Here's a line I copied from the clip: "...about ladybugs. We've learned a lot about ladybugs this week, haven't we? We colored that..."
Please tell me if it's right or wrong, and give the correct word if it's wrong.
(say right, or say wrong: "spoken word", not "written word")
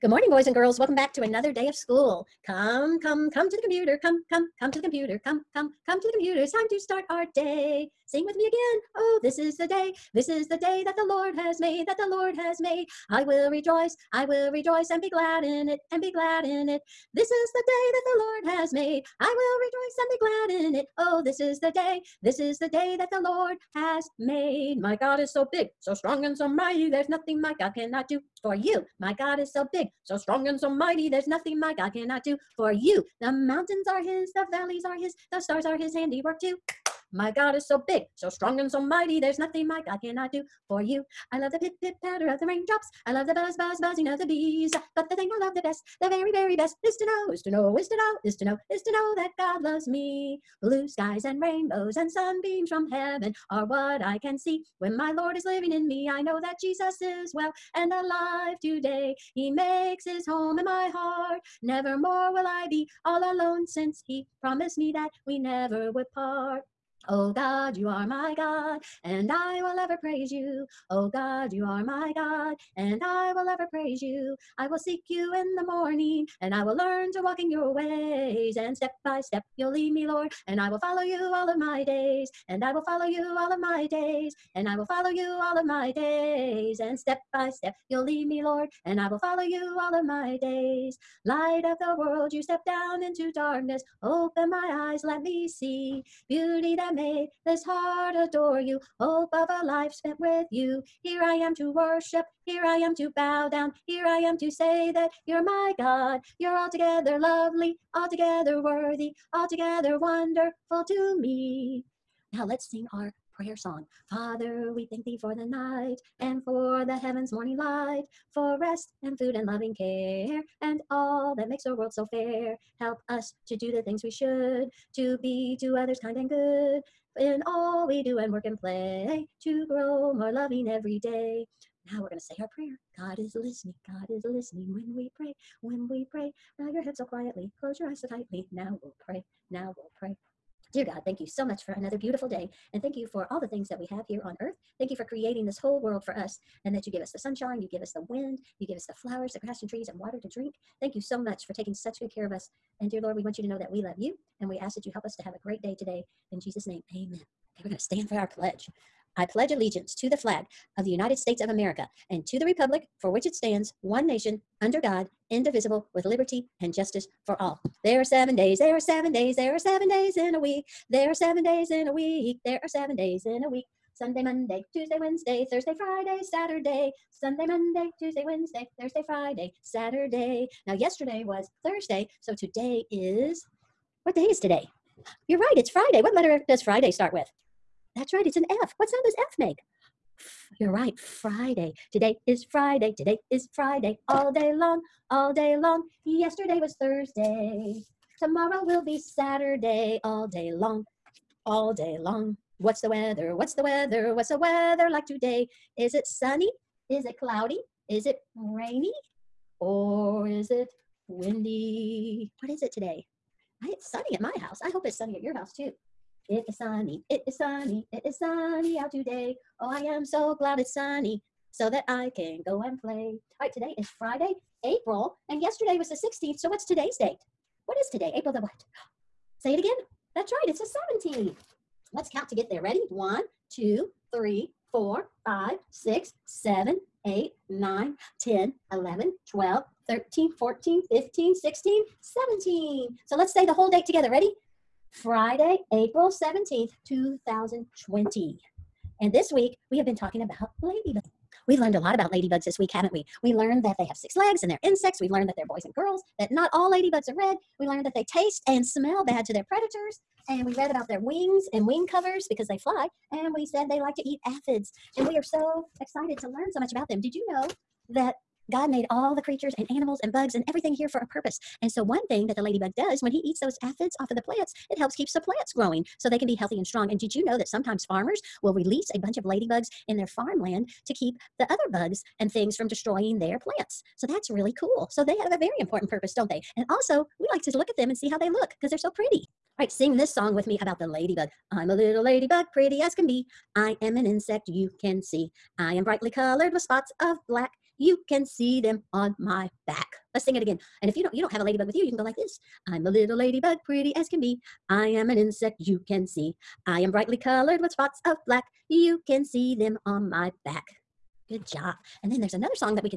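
wrong: "learned", not "colored".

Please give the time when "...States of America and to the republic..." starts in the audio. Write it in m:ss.
2:41.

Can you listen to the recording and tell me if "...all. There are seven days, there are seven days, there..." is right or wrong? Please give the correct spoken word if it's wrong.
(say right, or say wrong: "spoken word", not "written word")
right.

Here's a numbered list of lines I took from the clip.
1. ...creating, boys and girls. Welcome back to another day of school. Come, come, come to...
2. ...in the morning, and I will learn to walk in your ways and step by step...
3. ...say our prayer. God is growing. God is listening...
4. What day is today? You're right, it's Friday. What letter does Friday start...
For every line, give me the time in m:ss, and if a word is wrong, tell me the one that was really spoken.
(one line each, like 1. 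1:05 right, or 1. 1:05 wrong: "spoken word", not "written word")
1. 0:00 wrong: "morning", not "creating"
2. 1:15 right
3. 2:12 wrong: "listening", not "growing"
4. 3:04 right.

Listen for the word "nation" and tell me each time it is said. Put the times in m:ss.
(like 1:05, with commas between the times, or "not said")
2:44.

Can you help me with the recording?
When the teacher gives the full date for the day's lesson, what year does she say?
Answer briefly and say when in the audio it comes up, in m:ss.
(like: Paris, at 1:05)
2020, at 4:06.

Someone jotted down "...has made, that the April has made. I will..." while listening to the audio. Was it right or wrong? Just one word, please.
wrong.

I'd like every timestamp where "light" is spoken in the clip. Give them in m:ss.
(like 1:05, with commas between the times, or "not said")
1:31, 1:57.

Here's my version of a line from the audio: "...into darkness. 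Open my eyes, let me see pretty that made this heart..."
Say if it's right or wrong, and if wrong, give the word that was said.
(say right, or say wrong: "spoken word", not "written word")
wrong: "beauty", not "pretty".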